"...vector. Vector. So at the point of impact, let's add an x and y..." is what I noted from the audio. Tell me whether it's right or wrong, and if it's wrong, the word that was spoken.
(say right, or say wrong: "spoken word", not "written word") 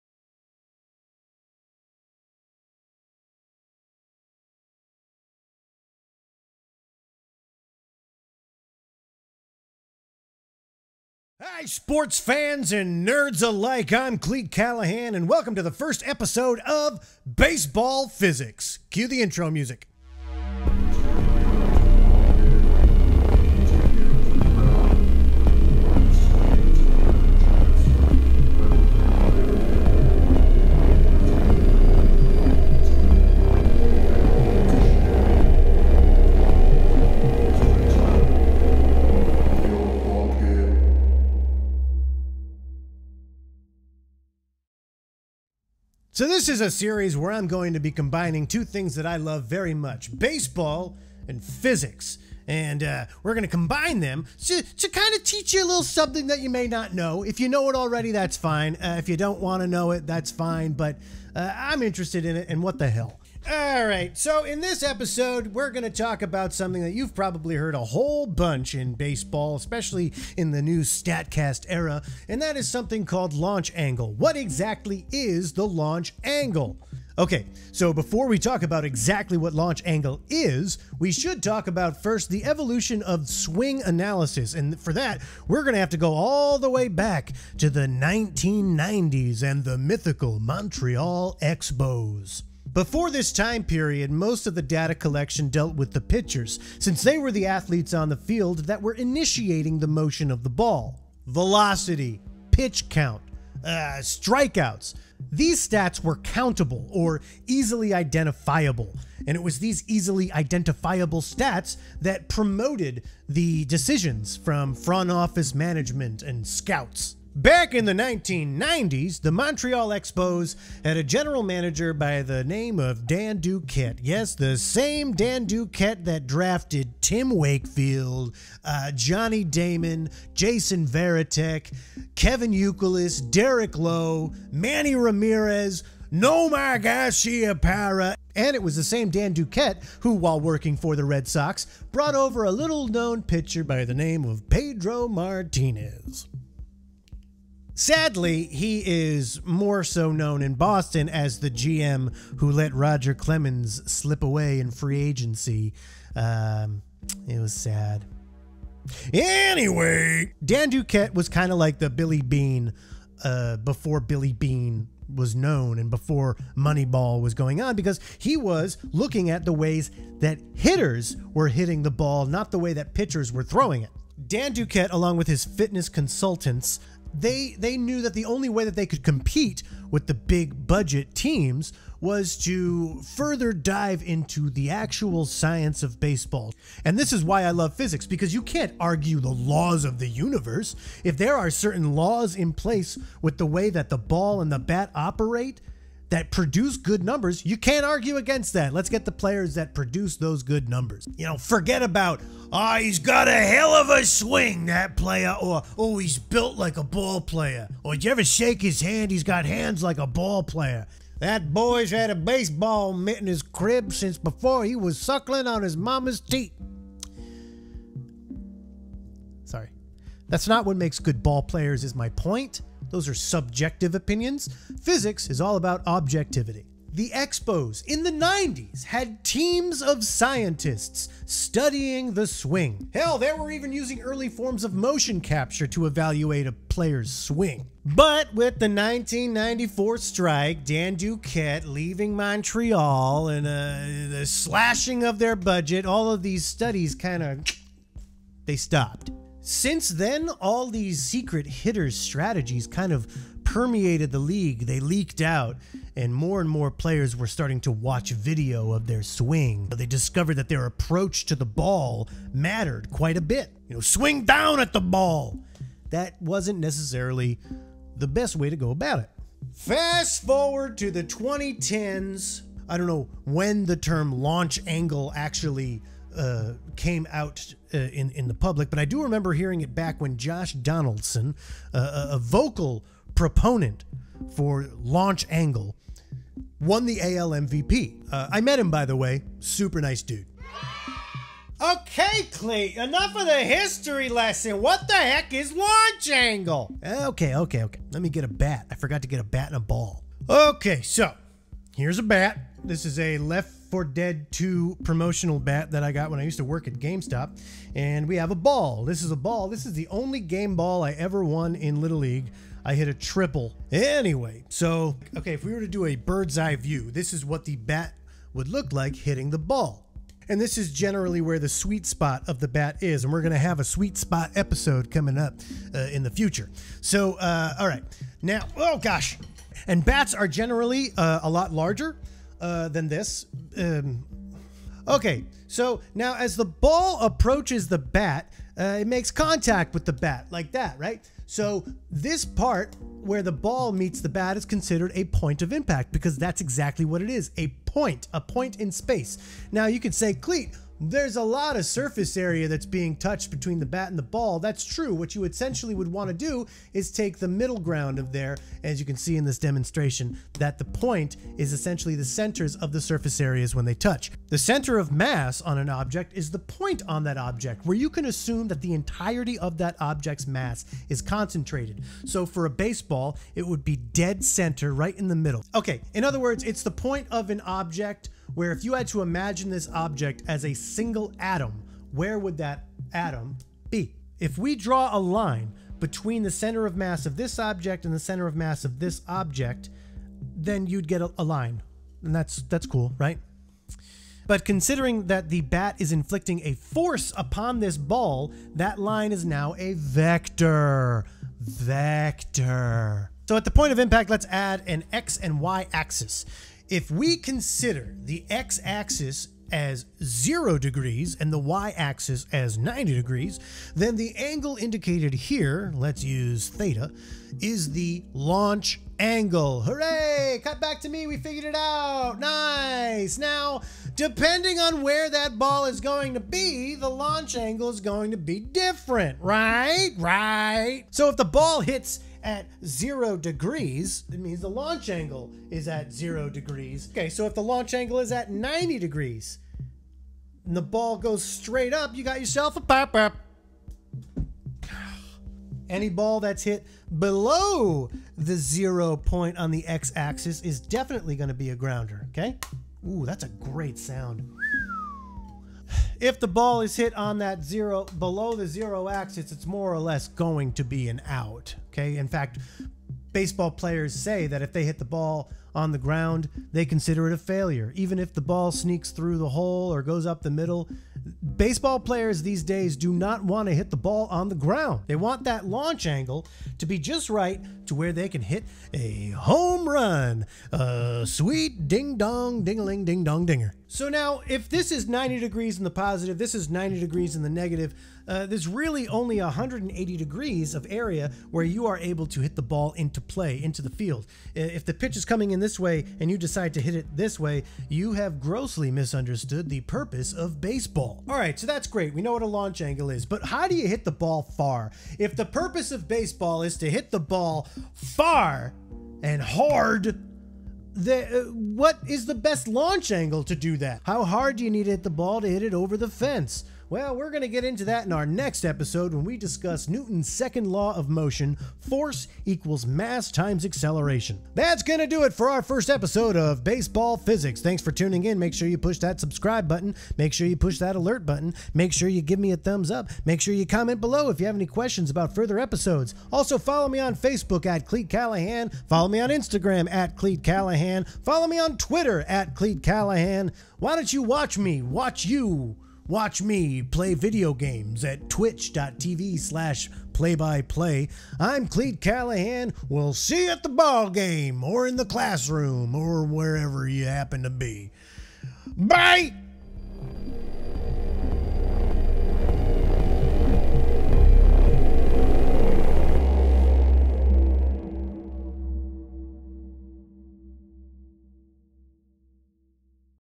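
right.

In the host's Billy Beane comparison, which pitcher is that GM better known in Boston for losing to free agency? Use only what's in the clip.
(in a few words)
Roger Clemens.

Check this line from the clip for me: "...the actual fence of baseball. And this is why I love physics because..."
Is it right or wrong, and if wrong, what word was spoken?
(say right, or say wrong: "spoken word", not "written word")
wrong: "science", not "fence".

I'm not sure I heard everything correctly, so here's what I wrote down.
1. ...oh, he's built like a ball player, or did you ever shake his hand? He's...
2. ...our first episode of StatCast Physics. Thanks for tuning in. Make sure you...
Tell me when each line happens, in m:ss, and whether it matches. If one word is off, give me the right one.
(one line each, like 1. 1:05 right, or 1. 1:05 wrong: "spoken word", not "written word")
1. 3:25 right
2. 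8:45 wrong: "Baseball", not "StatCast".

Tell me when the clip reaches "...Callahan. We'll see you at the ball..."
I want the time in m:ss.
9:11.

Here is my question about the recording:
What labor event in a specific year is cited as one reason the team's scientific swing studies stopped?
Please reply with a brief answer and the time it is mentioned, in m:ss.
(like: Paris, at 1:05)
1994 strike, at 3:58.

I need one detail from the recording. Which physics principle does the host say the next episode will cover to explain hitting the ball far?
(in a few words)
Newton's second law.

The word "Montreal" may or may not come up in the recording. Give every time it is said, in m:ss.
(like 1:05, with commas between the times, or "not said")
1:30, 1:59, 4:02.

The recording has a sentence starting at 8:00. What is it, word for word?
A sweet ding dong, ding a ling, ding dong, dinger.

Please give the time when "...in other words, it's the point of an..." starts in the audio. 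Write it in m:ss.
6:15.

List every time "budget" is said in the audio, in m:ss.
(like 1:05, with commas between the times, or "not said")
3:00, 4:05.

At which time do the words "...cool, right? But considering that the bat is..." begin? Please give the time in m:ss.
6:32.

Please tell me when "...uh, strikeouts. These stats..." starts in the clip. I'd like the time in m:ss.
1:43.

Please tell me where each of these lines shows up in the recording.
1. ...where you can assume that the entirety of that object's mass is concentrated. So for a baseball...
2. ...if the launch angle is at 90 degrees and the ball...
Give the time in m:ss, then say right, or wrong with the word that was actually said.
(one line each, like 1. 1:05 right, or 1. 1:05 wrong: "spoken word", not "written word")
1. 6:07 right
2. 7:17 right.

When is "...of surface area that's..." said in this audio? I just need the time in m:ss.
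5:51.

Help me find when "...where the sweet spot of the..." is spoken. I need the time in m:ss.
5:21.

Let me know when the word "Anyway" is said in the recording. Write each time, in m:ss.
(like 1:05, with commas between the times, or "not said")
2:39, 5:13.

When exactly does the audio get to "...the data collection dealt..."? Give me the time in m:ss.
1:34.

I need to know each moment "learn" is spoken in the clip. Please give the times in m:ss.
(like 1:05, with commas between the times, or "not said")
not said.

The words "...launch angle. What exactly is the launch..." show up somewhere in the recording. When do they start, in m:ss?
1:13.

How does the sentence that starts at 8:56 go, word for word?
Also, follow me on Facebook at Cleat Callahan.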